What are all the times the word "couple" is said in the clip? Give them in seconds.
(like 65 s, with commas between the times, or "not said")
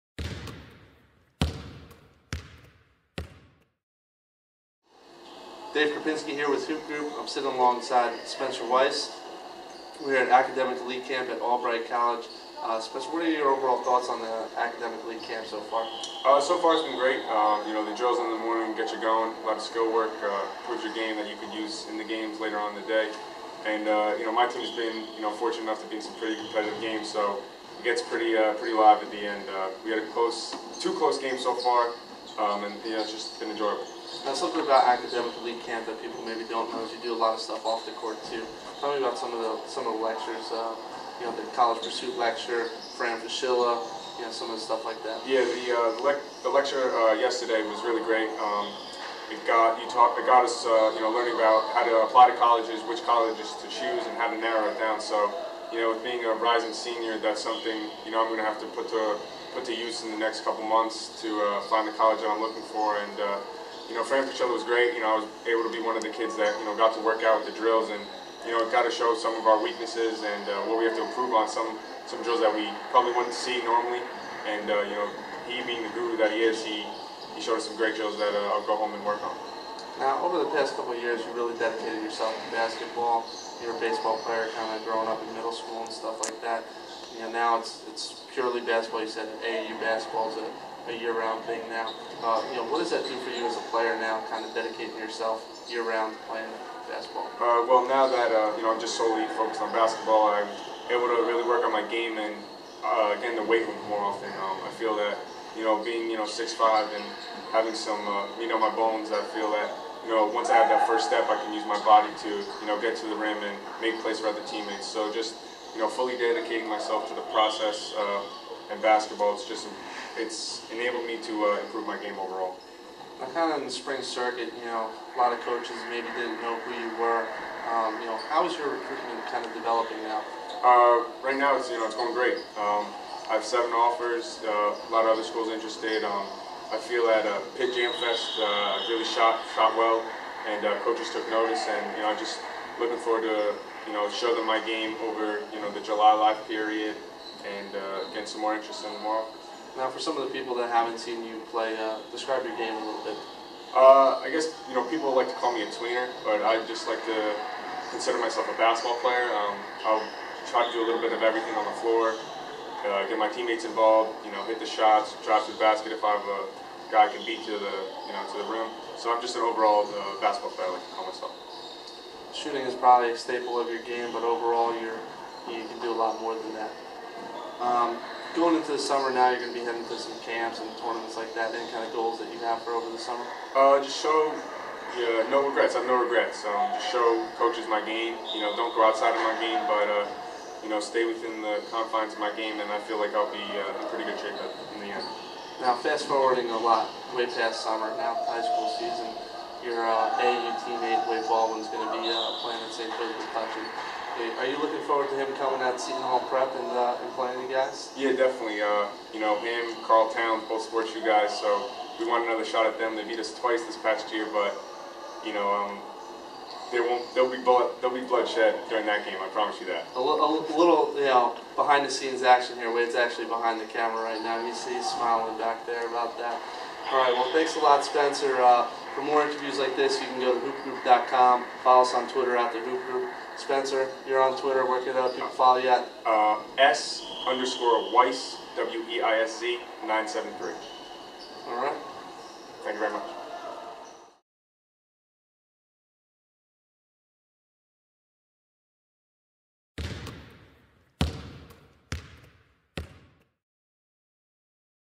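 60 s, 80 s.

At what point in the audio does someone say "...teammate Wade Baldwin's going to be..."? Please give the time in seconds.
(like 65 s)
200 s.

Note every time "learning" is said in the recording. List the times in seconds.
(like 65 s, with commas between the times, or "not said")
51 s.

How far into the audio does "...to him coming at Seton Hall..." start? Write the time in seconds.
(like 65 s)
205 s.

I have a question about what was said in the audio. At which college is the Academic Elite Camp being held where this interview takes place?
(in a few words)
Albright College.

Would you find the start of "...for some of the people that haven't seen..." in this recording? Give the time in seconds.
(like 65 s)
149 s.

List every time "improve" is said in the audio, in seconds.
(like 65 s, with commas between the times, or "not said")
71 s, 121 s.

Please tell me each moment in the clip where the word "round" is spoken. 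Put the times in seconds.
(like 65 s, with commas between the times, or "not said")
90 s, 95 s.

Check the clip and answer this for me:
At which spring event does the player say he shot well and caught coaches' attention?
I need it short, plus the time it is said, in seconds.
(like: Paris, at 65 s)
Pitt Jam Fest, at 137 s.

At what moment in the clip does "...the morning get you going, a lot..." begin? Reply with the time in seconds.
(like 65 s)
18 s.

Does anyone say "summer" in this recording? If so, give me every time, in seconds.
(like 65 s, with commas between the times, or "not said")
178 s, 182 s, 197 s.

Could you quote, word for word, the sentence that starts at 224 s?
You see, he's smiling back there about that.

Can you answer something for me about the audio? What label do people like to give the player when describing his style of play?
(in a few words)
Tweener.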